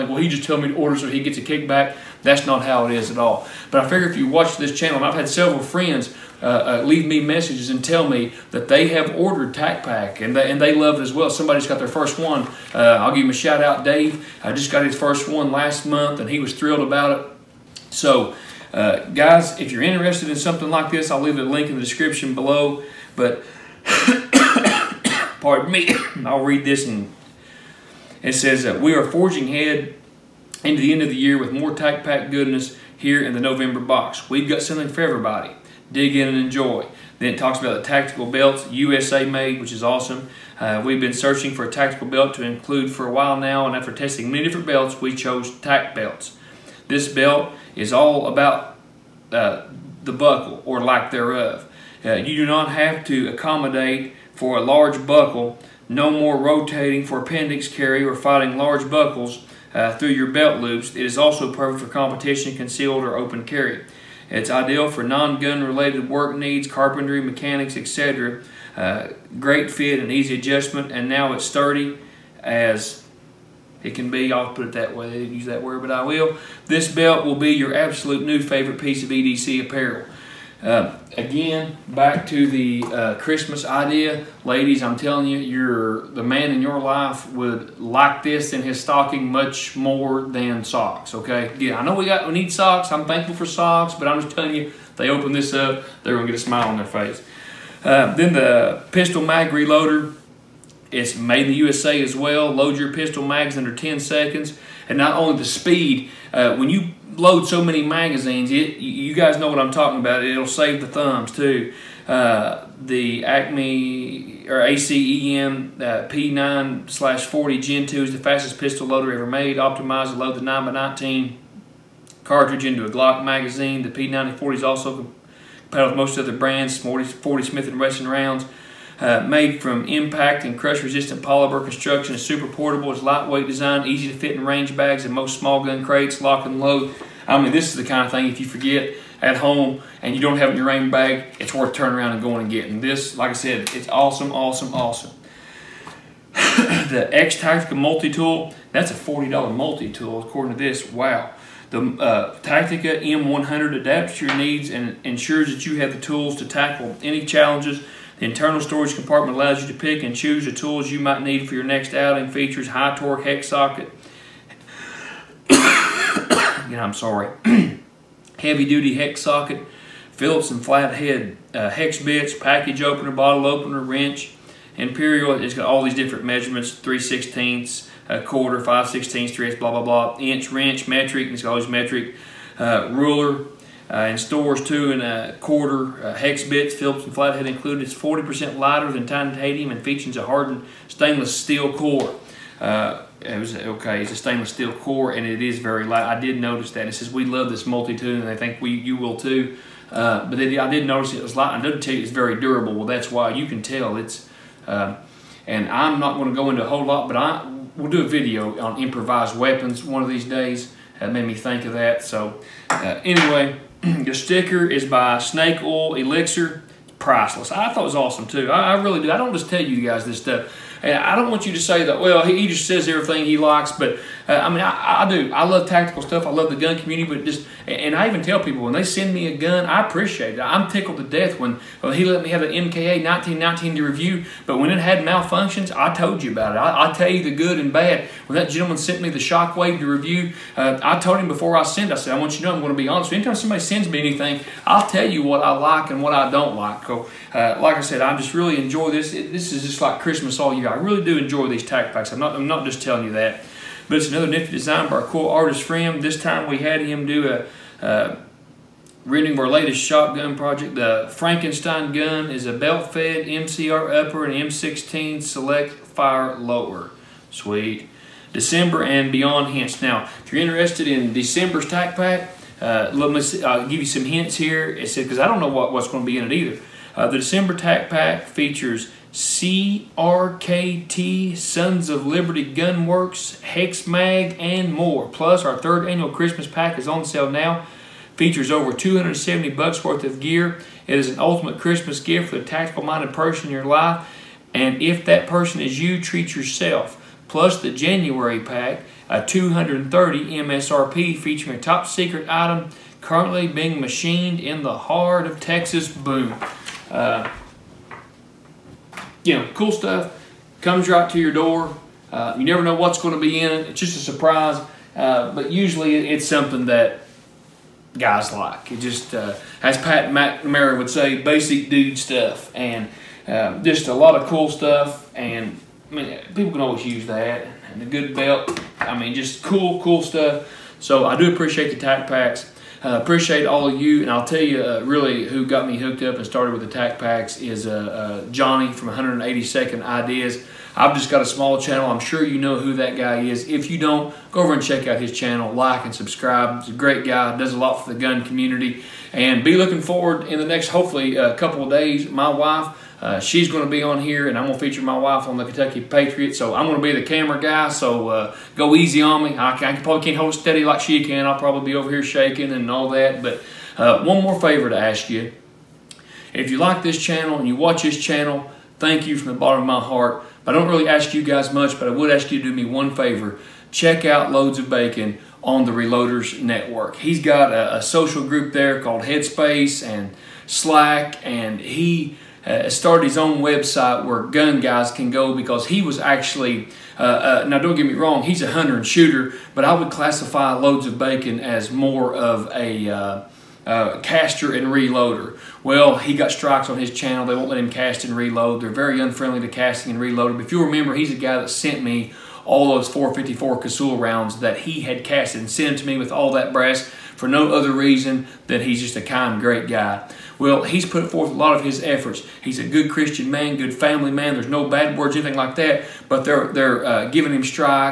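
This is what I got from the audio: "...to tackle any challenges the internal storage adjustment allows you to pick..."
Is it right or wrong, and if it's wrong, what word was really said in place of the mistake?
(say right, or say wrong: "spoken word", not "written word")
wrong: "compartment", not "adjustment".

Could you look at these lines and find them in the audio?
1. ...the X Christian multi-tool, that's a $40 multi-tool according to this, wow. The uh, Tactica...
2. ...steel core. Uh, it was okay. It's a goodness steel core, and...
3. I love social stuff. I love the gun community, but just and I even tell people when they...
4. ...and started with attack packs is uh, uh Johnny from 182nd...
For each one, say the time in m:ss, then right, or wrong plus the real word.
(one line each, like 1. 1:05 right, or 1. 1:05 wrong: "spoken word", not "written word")
1. 2:26 wrong: "Tactica", not "Christian"
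2. 3:11 wrong: "stainless", not "goodness"
3. 3:45 wrong: "tactical", not "social"
4. 5:36 right.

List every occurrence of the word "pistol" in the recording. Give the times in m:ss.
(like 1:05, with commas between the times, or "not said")
1:38, 1:42, 1:58.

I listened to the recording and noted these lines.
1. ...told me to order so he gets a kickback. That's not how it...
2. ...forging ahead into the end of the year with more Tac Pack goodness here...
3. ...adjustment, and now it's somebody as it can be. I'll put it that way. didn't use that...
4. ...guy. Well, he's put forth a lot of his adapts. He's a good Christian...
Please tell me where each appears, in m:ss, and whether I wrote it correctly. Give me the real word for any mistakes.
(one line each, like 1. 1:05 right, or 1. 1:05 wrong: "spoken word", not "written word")
1. 0:00 right
2. 0:29 right
3. 1:10 wrong: "sturdy", not "somebody"
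4. 6:49 wrong: "efforts", not "adapts".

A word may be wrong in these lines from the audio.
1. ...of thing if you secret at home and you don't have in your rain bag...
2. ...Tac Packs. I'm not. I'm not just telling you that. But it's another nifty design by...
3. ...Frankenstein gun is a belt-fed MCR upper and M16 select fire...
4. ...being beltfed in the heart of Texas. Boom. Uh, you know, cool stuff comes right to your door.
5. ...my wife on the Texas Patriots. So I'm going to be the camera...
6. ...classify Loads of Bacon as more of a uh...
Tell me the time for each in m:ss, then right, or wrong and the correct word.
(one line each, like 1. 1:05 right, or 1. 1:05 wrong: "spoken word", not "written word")
1. 2:18 wrong: "forget", not "secret"
2. 4:11 right
3. 4:21 right
4. 5:03 wrong: "machined", not "beltfed"
5. 5:54 wrong: "Kentucky", not "Texas"
6. 6:29 right.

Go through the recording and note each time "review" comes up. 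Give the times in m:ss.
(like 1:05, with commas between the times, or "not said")
3:53, 3:59.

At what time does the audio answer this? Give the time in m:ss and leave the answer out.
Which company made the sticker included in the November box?
3:35.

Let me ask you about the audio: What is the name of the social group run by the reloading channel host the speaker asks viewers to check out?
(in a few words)
Headspace and Slack.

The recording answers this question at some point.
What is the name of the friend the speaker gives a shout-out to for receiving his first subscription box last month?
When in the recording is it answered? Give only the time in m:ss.
0:13.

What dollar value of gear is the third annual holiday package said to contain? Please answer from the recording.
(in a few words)
over $270.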